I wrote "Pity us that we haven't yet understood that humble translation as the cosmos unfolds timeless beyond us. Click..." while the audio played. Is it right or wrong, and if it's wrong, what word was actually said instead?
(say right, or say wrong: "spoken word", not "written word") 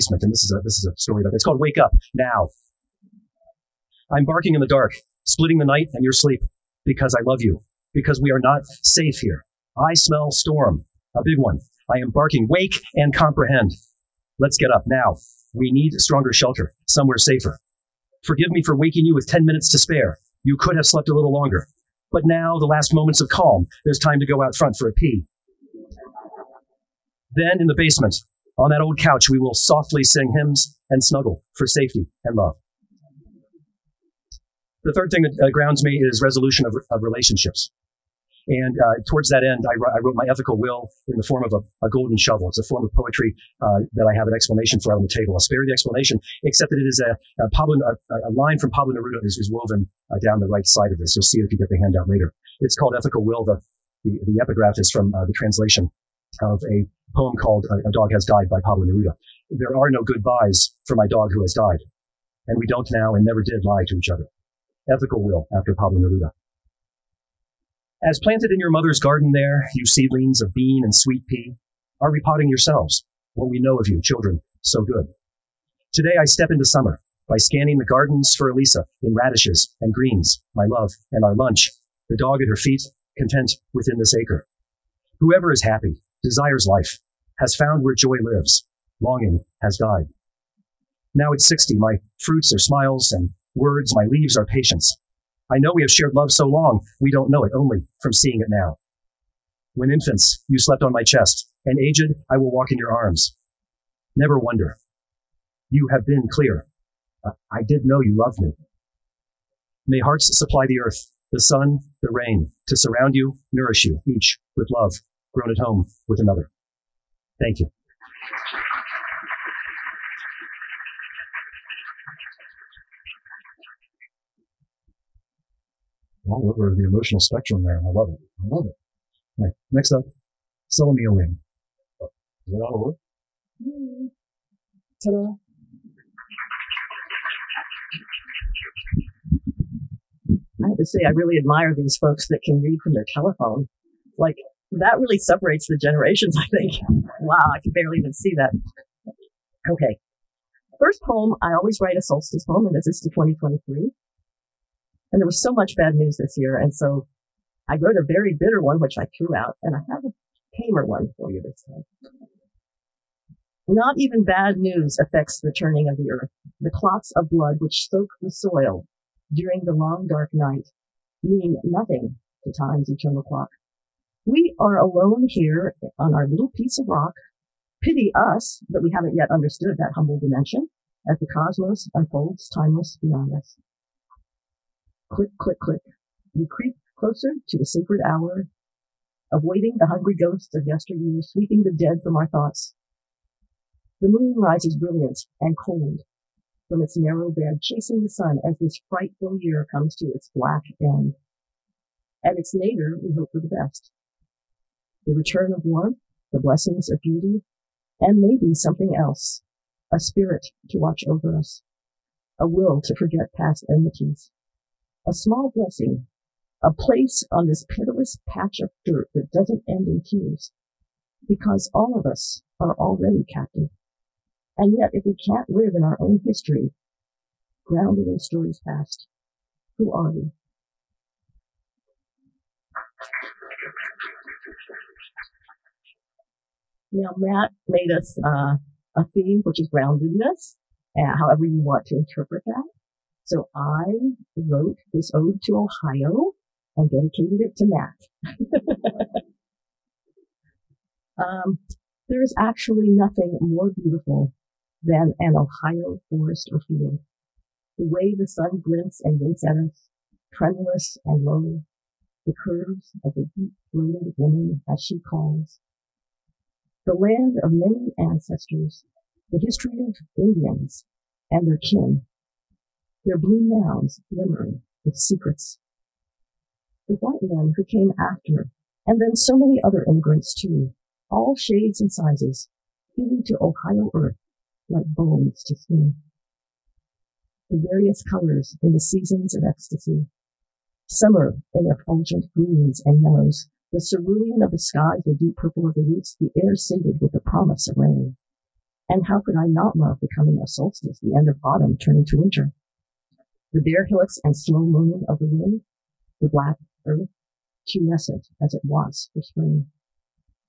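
wrong: "dimension", not "translation".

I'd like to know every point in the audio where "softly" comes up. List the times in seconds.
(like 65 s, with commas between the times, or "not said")
29 s.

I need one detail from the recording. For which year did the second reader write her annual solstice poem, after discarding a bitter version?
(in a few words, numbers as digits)
2023.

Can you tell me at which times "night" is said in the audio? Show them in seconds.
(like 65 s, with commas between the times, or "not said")
5 s, 170 s.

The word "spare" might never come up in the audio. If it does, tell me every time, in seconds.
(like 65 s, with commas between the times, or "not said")
19 s, 45 s.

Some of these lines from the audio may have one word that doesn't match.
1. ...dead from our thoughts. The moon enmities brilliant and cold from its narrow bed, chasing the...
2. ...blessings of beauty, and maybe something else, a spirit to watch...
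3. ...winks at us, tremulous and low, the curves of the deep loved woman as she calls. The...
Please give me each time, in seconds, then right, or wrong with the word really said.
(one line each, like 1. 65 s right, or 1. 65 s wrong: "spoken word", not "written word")
1. 191 s wrong: "rises", not "enmities"
2. 206 s right
3. 259 s wrong: "throated", not "loved".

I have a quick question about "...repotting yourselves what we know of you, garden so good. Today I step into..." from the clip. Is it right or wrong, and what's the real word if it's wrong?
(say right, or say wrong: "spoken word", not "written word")
wrong: "children", not "garden".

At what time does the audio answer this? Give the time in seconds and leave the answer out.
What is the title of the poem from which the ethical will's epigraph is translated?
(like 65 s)
57 s.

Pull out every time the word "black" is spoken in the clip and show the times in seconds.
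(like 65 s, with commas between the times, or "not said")
200 s, 306 s.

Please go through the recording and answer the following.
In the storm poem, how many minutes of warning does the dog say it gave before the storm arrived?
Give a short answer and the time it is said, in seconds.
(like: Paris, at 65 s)
10, at 19 s.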